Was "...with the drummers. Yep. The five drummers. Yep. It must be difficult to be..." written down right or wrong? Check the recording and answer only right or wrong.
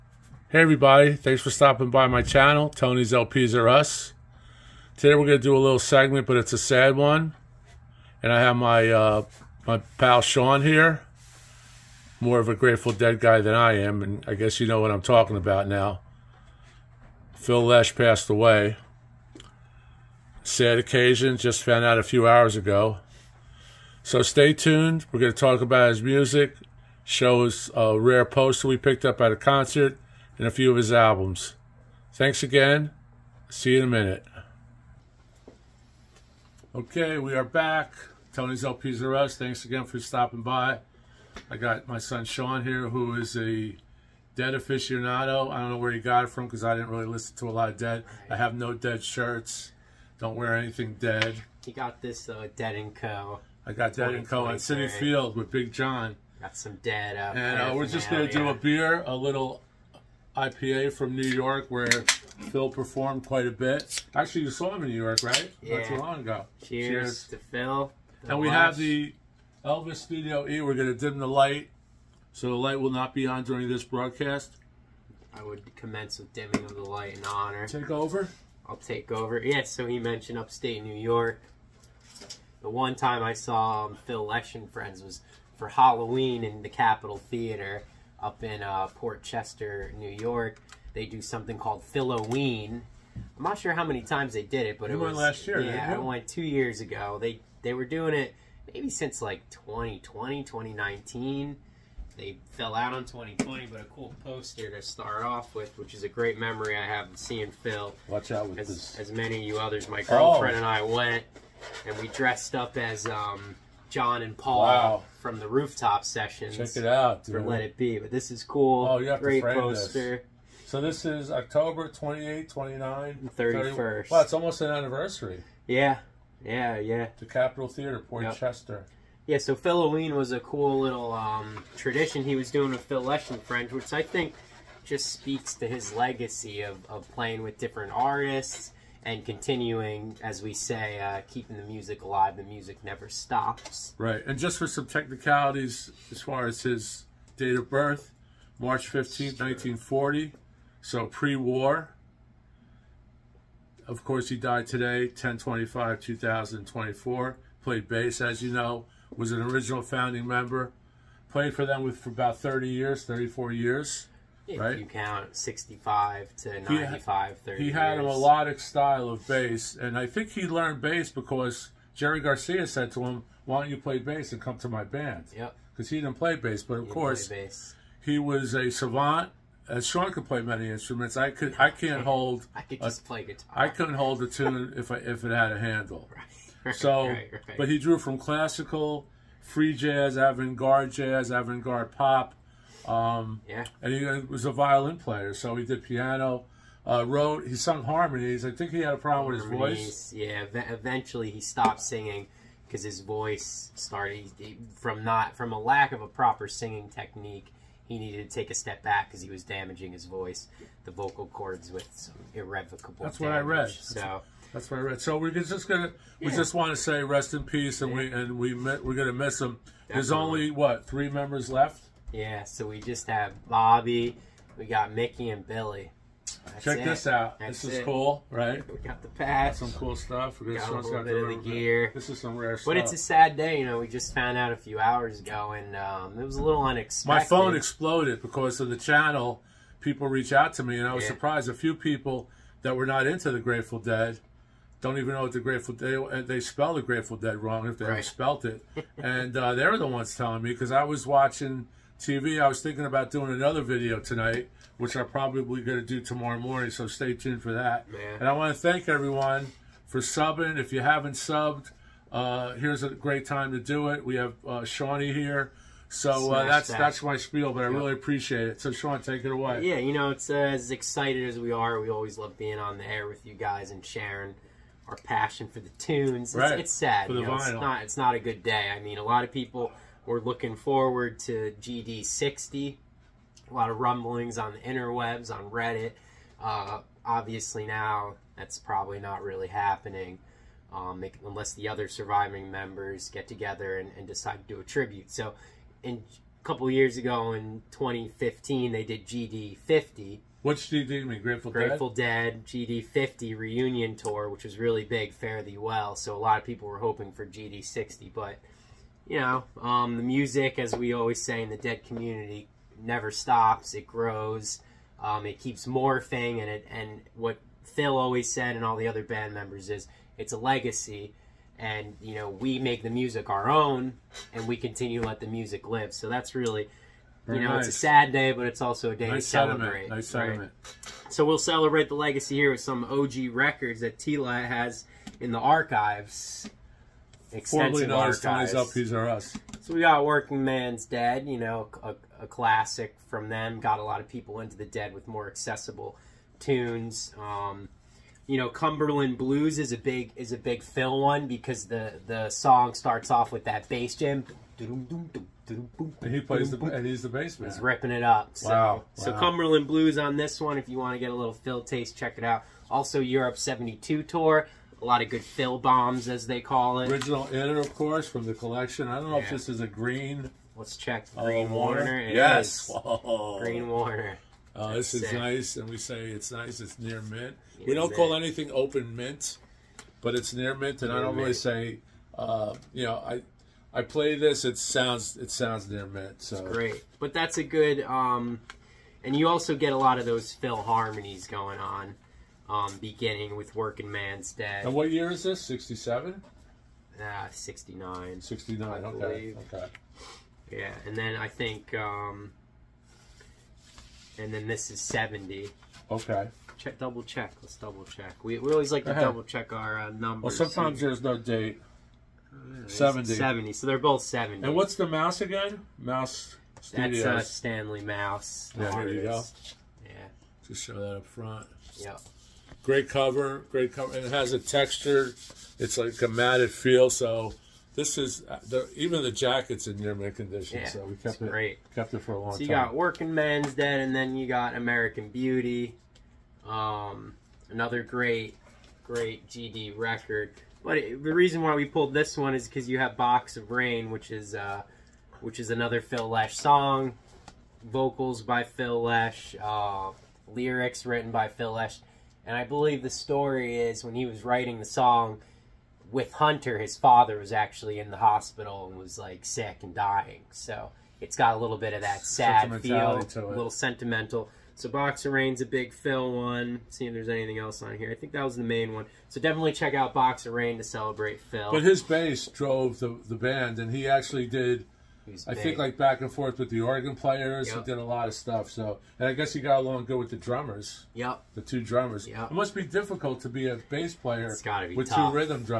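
wrong.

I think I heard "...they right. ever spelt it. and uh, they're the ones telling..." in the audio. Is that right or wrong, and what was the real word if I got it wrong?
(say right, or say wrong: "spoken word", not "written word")
right.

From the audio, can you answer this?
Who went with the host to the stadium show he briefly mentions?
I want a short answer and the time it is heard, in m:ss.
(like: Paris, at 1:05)
Big John, at 0:55.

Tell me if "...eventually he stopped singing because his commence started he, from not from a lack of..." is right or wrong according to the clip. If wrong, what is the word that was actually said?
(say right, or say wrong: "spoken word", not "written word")
wrong: "voice", not "commence".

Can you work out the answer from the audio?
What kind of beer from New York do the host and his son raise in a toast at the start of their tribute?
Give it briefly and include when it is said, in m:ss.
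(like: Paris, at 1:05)
IPA, at 1:00.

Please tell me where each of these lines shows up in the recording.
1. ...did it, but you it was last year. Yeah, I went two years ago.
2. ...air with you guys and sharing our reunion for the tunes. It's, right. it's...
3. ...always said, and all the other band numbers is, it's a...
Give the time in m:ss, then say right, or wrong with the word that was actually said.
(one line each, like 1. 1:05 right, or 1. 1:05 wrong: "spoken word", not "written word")
1. 1:34 right
2. 4:32 wrong: "passion", not "reunion"
3. 5:17 wrong: "members", not "numbers".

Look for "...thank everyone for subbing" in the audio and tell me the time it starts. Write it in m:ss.
4:18.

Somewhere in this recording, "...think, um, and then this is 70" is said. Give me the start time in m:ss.
6:41.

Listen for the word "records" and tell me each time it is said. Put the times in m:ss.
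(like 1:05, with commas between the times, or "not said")
5:33, 7:19.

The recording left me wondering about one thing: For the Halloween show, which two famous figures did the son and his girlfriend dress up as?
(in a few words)
John and Paul.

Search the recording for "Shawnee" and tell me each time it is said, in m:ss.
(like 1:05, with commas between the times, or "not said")
4:24.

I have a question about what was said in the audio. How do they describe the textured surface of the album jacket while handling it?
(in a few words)
matted feel.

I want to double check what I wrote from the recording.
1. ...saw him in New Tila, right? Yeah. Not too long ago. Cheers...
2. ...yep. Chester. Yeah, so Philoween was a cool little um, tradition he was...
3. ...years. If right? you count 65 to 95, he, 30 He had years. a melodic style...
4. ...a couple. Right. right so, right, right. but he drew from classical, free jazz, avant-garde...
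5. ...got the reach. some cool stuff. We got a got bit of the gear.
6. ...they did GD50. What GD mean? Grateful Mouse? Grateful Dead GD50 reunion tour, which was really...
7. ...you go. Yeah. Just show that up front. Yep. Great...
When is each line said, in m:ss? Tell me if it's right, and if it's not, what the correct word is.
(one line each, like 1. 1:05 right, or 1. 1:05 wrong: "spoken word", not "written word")
1. 1:04 wrong: "York", not "Tila"
2. 2:08 right
3. 2:43 right
4. 3:05 wrong: "handle", not "couple"
5. 3:48 wrong: "patch", not "reach"
6. 4:58 wrong: "Dead", not "Mouse"
7. 6:58 right.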